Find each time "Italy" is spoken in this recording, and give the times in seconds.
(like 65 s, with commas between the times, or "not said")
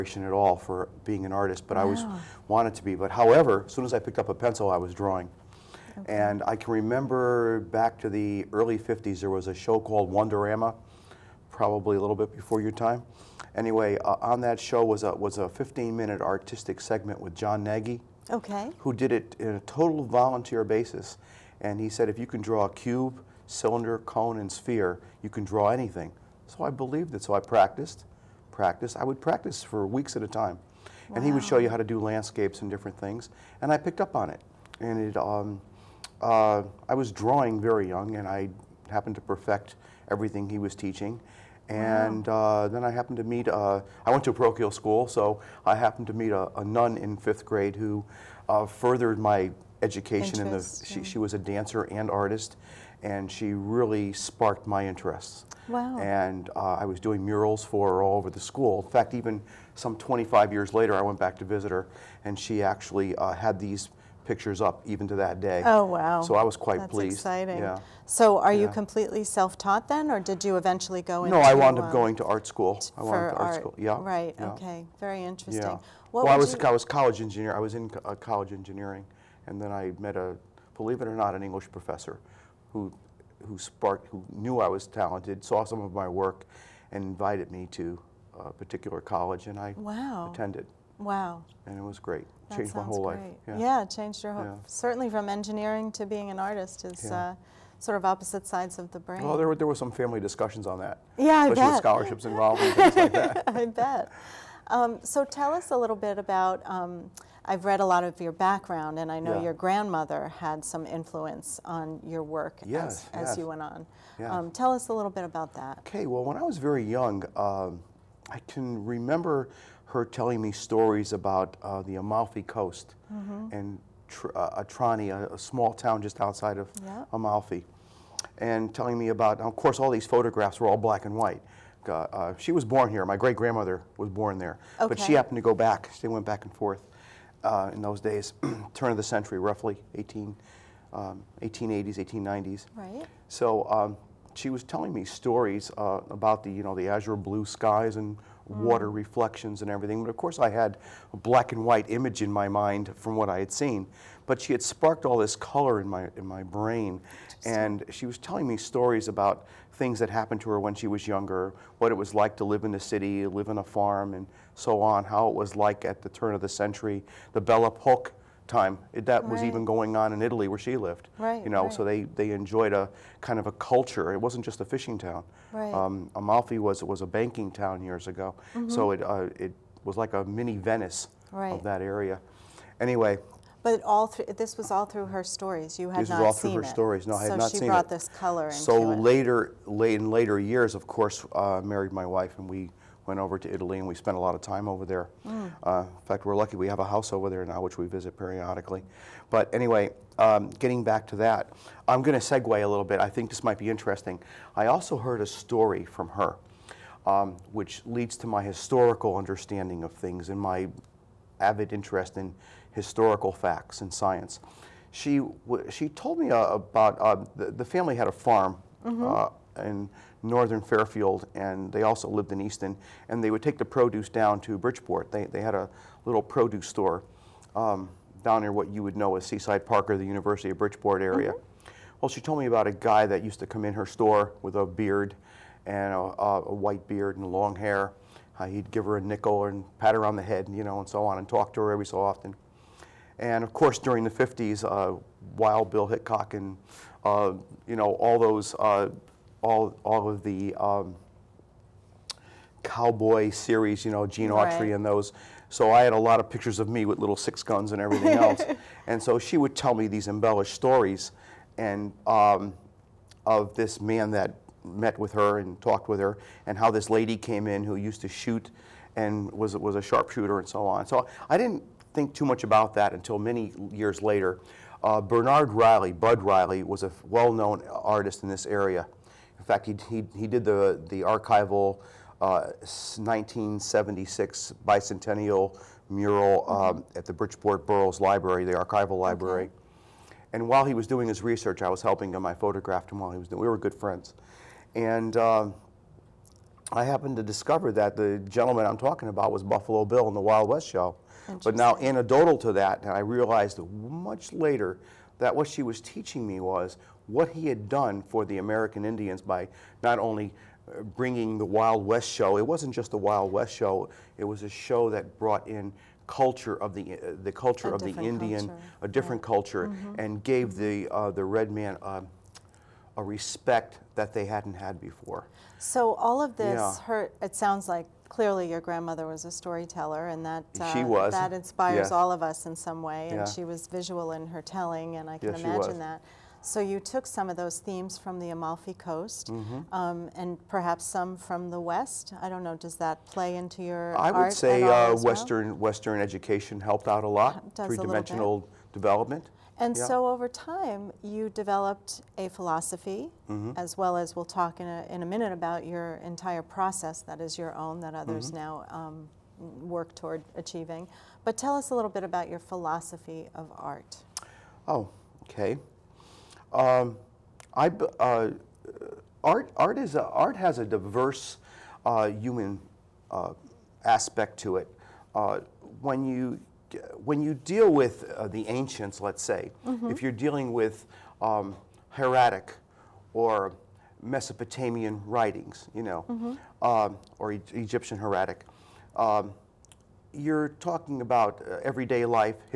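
170 s, 193 s.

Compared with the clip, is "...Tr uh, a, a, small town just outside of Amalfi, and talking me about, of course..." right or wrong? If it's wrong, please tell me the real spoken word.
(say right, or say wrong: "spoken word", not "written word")
wrong: "telling", not "talking".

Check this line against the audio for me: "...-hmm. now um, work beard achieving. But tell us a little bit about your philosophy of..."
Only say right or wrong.
wrong.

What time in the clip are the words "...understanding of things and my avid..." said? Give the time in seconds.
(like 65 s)
209 s.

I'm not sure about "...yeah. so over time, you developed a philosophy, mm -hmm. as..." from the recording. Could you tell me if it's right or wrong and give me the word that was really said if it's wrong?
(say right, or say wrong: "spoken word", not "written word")
right.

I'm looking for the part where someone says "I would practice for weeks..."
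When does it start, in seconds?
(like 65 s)
28 s.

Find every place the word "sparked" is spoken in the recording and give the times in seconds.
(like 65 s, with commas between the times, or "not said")
54 s, 83 s, 154 s.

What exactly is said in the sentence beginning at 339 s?
um, and perhaps some from the West.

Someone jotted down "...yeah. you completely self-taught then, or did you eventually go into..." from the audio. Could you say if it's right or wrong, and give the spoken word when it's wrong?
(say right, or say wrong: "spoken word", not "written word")
right.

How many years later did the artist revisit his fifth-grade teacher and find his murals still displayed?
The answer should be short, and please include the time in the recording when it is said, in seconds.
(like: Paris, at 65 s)
25, at 59 s.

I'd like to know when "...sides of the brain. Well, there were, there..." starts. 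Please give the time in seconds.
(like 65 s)
98 s.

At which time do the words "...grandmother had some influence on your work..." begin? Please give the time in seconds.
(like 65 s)
109 s.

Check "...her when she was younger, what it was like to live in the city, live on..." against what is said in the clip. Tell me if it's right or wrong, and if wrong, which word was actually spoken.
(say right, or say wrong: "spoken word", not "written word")
right.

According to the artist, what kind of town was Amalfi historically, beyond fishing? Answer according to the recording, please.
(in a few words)
A banking town.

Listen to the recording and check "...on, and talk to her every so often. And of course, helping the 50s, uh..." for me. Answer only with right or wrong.
wrong.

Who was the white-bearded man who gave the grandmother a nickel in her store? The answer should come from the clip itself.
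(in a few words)
Buffalo Bill.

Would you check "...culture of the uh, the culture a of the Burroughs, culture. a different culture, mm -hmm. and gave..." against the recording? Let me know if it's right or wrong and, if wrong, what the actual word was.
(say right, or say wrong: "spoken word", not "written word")
wrong: "Indian", not "Burroughs".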